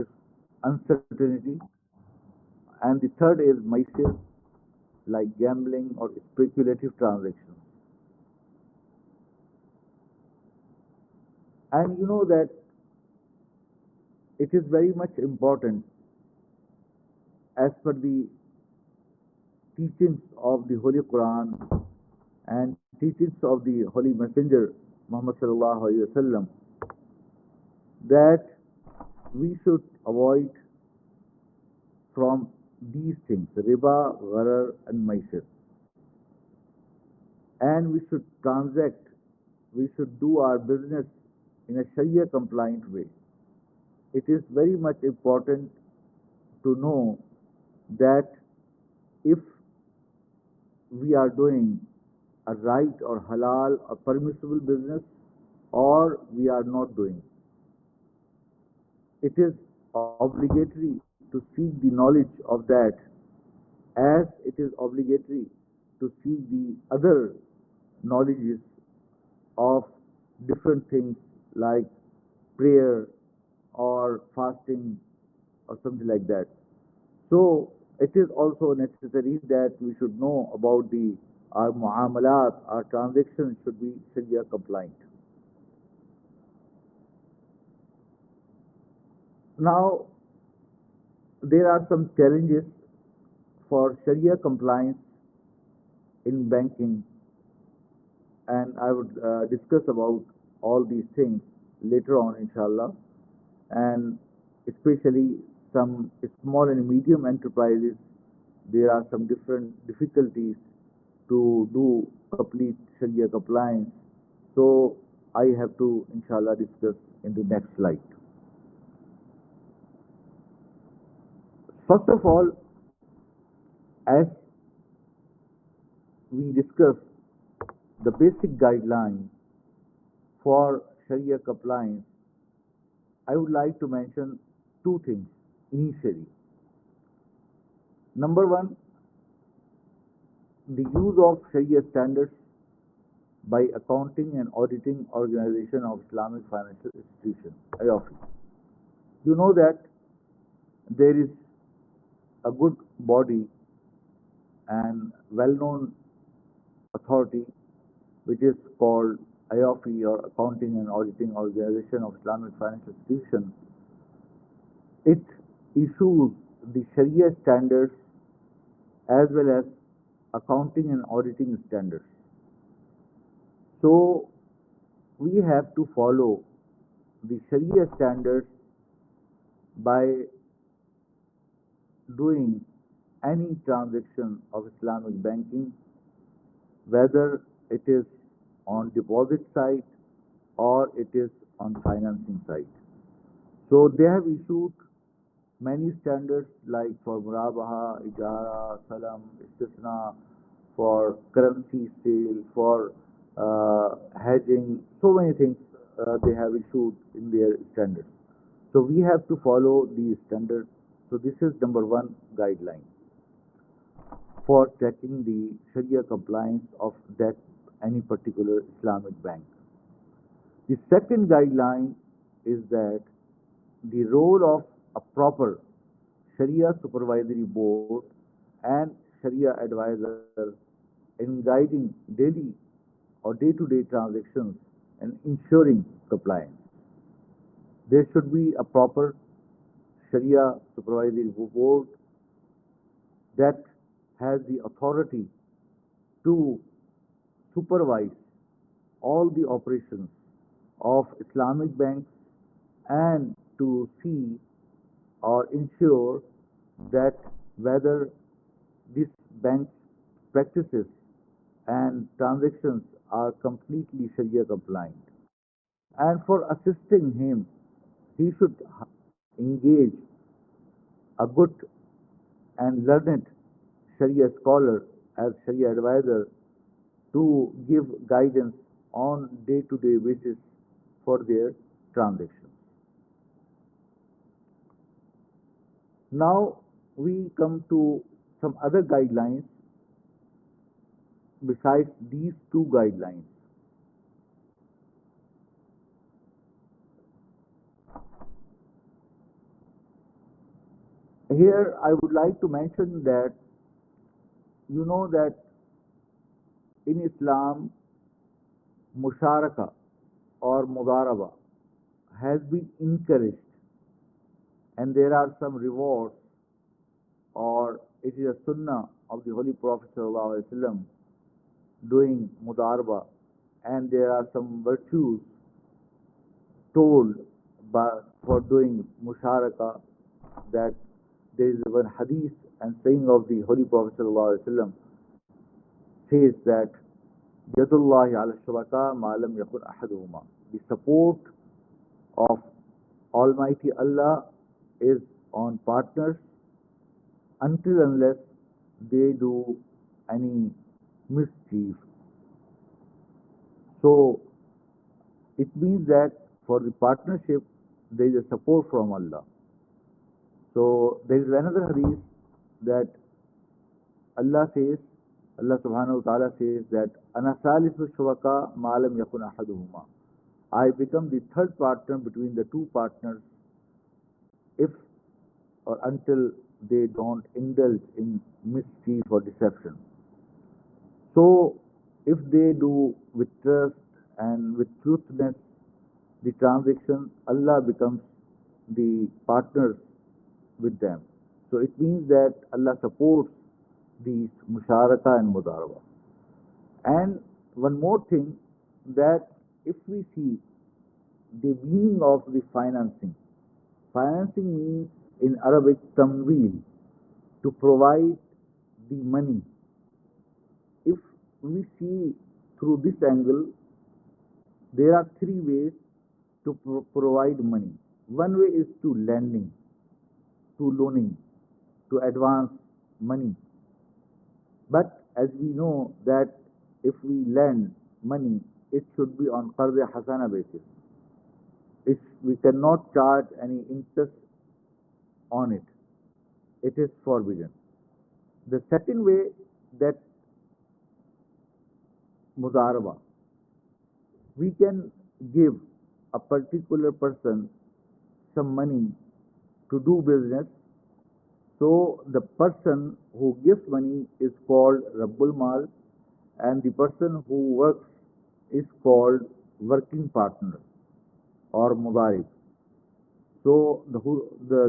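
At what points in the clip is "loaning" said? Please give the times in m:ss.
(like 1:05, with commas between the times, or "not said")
7:00.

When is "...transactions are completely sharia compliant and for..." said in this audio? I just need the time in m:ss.
4:22.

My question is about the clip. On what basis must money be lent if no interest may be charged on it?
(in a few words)
qarz hasana.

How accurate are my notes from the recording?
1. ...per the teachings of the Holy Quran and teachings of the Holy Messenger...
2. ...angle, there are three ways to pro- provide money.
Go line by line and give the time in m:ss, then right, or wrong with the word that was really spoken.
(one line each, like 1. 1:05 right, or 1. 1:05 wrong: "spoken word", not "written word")
1. 0:17 right
2. 6:52 right.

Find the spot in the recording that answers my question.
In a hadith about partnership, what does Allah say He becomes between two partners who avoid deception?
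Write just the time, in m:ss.
6:11.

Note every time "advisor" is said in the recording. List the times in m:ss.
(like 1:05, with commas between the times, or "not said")
3:49, 4:35.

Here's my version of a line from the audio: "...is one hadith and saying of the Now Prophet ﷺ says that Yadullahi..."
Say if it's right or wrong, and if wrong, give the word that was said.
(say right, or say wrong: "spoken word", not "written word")
wrong: "Holy", not "Now".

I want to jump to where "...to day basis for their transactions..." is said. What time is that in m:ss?
4:39.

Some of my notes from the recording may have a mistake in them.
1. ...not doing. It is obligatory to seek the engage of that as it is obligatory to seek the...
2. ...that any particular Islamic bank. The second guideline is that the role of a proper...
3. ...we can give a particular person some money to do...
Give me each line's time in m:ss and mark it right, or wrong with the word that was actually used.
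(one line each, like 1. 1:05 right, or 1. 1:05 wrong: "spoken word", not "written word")
1. 0:56 wrong: "knowledge", not "engage"
2. 3:37 right
3. 7:24 right.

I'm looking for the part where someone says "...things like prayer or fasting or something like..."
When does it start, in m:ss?
1:10.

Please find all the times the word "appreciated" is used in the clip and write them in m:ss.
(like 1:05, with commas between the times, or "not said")
not said.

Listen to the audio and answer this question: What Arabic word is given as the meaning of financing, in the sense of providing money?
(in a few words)
tamwil.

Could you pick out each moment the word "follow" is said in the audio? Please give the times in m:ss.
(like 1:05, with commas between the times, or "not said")
2:55, 3:29.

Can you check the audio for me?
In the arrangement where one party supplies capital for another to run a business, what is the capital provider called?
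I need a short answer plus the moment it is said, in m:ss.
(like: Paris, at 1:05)
Rabbul Mal, at 7:34.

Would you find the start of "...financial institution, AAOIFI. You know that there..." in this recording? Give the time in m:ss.
2:26.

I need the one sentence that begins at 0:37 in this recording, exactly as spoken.
And we should transact, we should do our business in a Sharia compliant way.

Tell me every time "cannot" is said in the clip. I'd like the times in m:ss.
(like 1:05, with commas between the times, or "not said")
7:12.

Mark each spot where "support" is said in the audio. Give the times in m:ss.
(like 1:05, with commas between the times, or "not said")
5:40, 5:58, 6:32.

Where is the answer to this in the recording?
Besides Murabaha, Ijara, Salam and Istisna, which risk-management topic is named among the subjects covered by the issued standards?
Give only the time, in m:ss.
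3:24.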